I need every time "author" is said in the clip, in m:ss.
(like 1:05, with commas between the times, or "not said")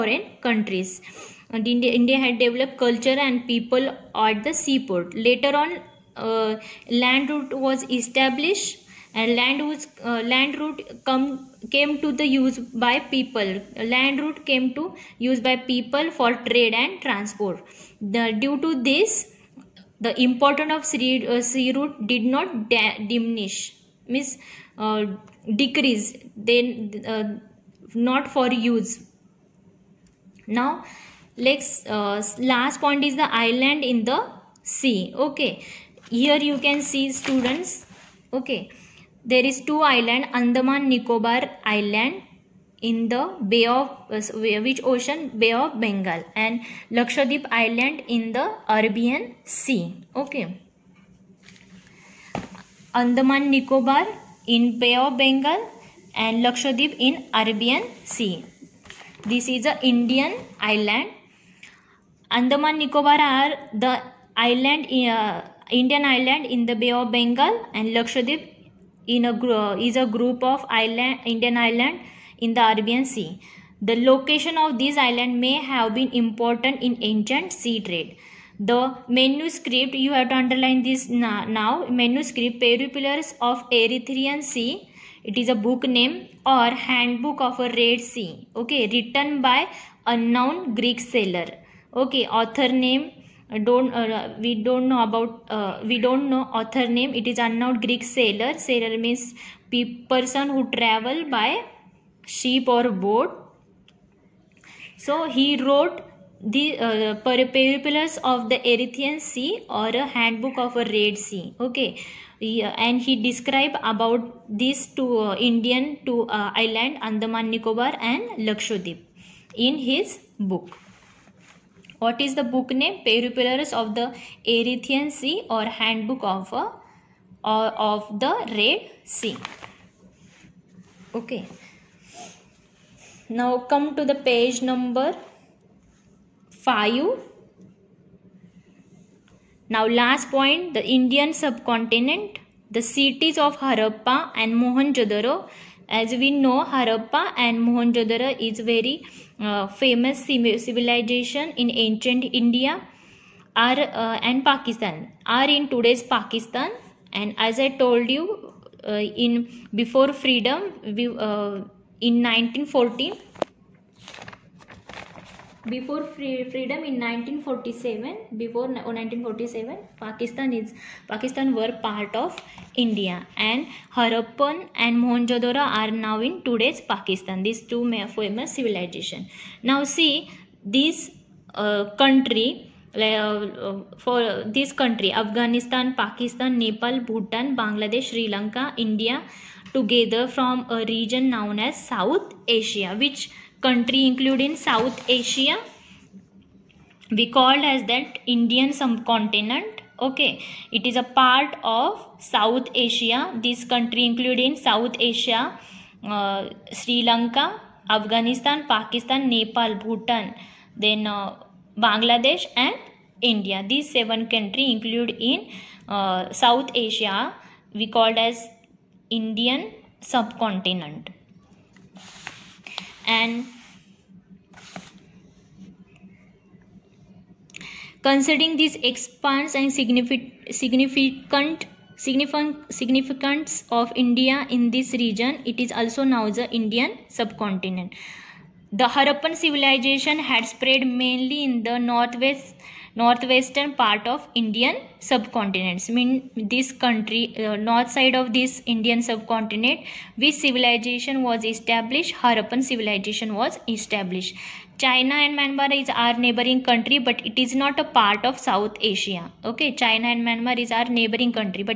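1:32, 1:36.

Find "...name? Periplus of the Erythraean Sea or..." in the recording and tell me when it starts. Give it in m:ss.
2:02.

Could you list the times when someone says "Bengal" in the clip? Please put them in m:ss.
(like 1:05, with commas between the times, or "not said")
0:45, 0:55, 1:07.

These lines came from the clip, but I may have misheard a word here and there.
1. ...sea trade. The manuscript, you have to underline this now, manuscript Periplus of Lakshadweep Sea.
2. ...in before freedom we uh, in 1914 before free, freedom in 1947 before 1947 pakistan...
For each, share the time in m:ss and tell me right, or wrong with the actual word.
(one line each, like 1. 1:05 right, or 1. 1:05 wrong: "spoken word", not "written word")
1. 1:17 wrong: "Erythraean", not "Lakshadweep"
2. 2:39 right.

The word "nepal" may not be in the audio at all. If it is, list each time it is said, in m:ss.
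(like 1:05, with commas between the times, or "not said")
3:06, 3:29.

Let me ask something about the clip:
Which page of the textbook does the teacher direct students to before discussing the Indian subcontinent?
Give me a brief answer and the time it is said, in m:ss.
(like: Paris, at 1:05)
5, at 2:14.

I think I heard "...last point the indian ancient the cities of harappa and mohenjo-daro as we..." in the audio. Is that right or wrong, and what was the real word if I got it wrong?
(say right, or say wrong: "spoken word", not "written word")
wrong: "subcontinent", not "ancient".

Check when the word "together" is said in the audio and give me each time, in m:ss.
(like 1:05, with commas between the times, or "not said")
3:09.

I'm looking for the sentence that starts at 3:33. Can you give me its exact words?
These seven countries include in uh, South Asia we called as Indian subcontinent.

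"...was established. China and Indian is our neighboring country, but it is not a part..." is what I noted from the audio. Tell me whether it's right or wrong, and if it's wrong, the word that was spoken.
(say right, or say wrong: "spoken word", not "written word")
wrong: "Myanmar", not "Indian".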